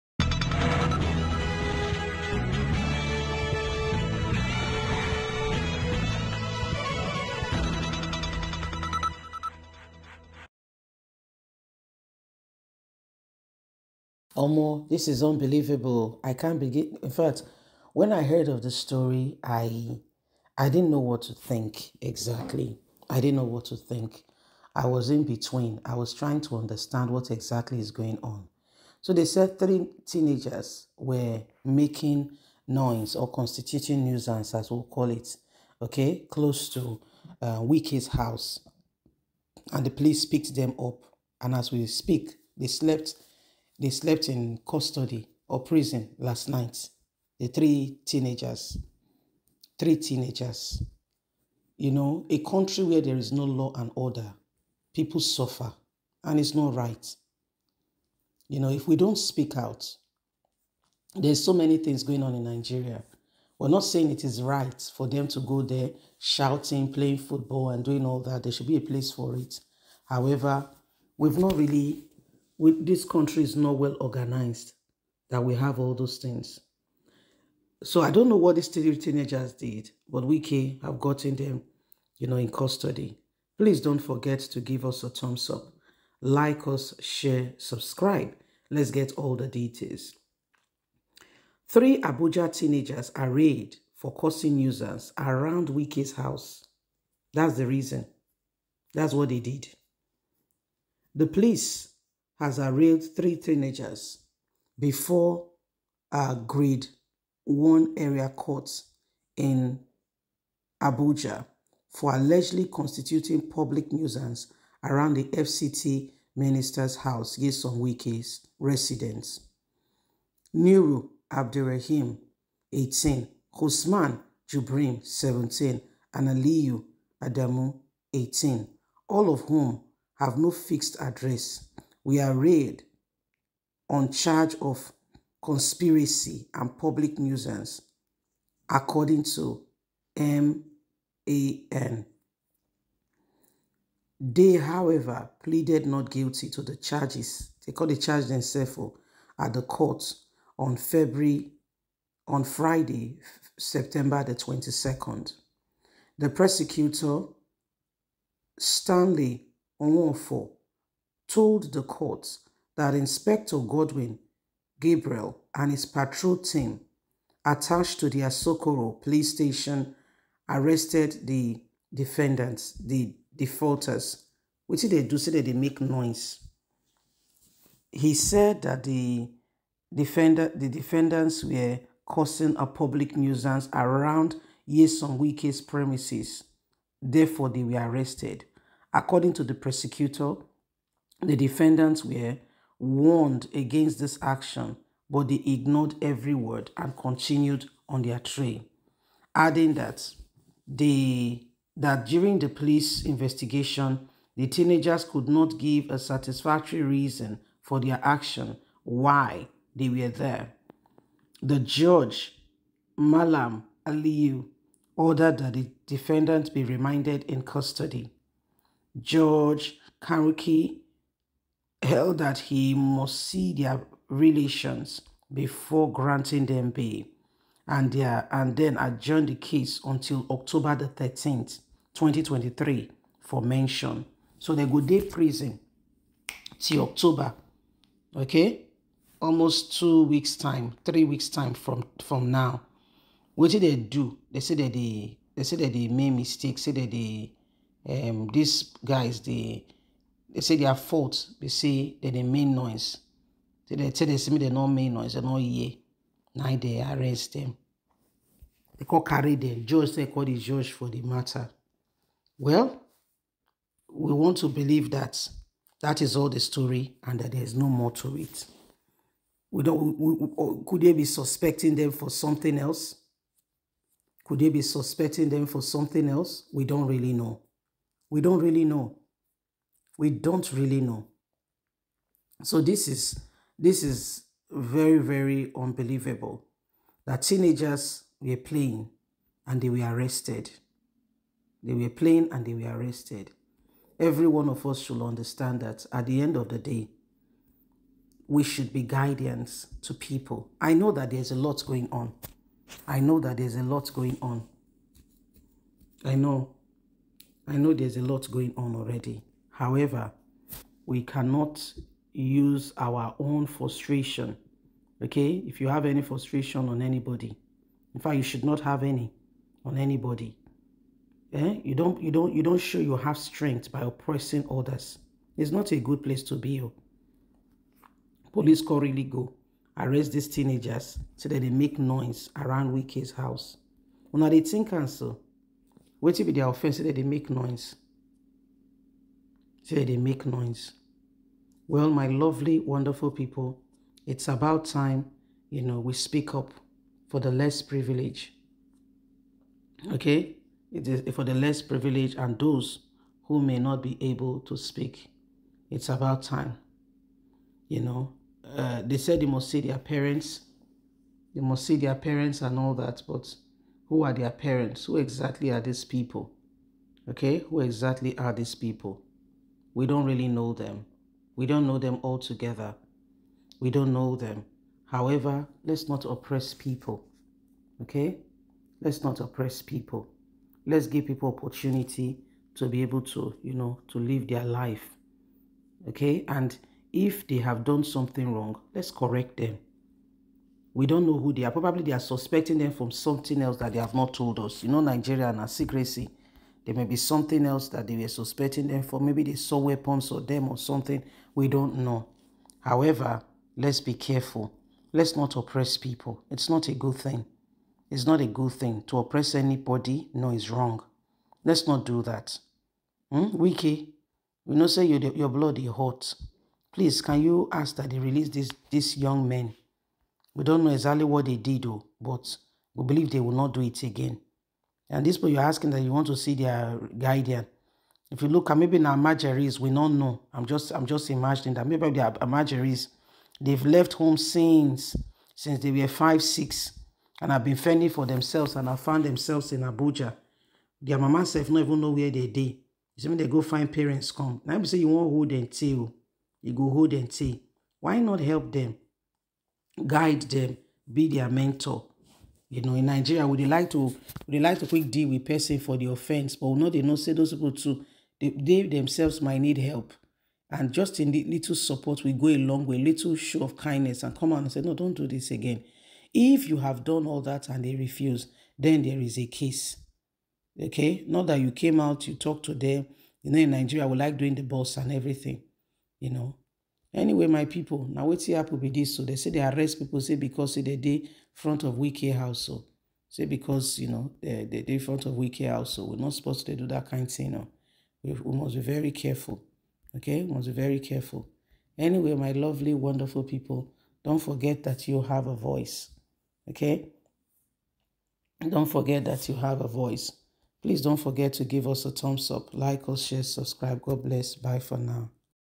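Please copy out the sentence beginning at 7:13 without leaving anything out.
They've left home since since they were five, six, and have been fending for themselves and have found themselves in Abuja.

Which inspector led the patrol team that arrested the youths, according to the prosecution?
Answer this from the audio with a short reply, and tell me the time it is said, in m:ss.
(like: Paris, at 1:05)
Godwin Gabriel, at 2:43.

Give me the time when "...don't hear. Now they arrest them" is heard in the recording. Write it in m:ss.
4:15.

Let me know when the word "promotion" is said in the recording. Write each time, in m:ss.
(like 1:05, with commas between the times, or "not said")
not said.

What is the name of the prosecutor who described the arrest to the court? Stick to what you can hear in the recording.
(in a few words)
Stanley Onwofo.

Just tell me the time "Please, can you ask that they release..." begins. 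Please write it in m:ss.
6:56.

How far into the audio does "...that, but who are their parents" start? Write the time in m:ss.
6:02.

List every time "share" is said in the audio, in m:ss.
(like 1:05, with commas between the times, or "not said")
1:26, 8:23.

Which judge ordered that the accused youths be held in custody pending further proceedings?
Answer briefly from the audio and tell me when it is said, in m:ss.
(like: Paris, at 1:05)
Malam Aliyu, at 3:32.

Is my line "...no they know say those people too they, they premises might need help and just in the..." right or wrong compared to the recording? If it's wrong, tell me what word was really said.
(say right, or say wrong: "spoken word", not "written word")
wrong: "themselves", not "premises".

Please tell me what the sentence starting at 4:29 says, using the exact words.
We don't, we, we, oh, could they be suspecting them for something else?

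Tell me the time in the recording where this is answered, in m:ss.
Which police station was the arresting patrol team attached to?
2:48.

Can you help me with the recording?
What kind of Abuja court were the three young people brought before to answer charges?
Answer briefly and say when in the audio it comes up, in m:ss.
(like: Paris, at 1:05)
Grade one area court, at 1:46.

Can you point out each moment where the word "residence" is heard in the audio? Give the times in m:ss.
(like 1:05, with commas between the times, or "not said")
1:58.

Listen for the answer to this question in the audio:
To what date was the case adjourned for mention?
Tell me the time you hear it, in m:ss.
3:50.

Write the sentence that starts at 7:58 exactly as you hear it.
so they say they arrest people.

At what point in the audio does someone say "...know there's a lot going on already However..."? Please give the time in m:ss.
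5:07.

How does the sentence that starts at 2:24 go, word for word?
They, however, pleaded not guilty to the charges.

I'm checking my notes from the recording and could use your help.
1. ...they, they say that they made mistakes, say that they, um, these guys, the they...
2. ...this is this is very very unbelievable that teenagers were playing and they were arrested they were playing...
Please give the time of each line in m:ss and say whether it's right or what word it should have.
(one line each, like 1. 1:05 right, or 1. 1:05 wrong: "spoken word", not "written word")
1. 4:04 right
2. 4:42 right.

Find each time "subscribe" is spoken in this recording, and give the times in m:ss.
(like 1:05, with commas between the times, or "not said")
1:27, 8:23.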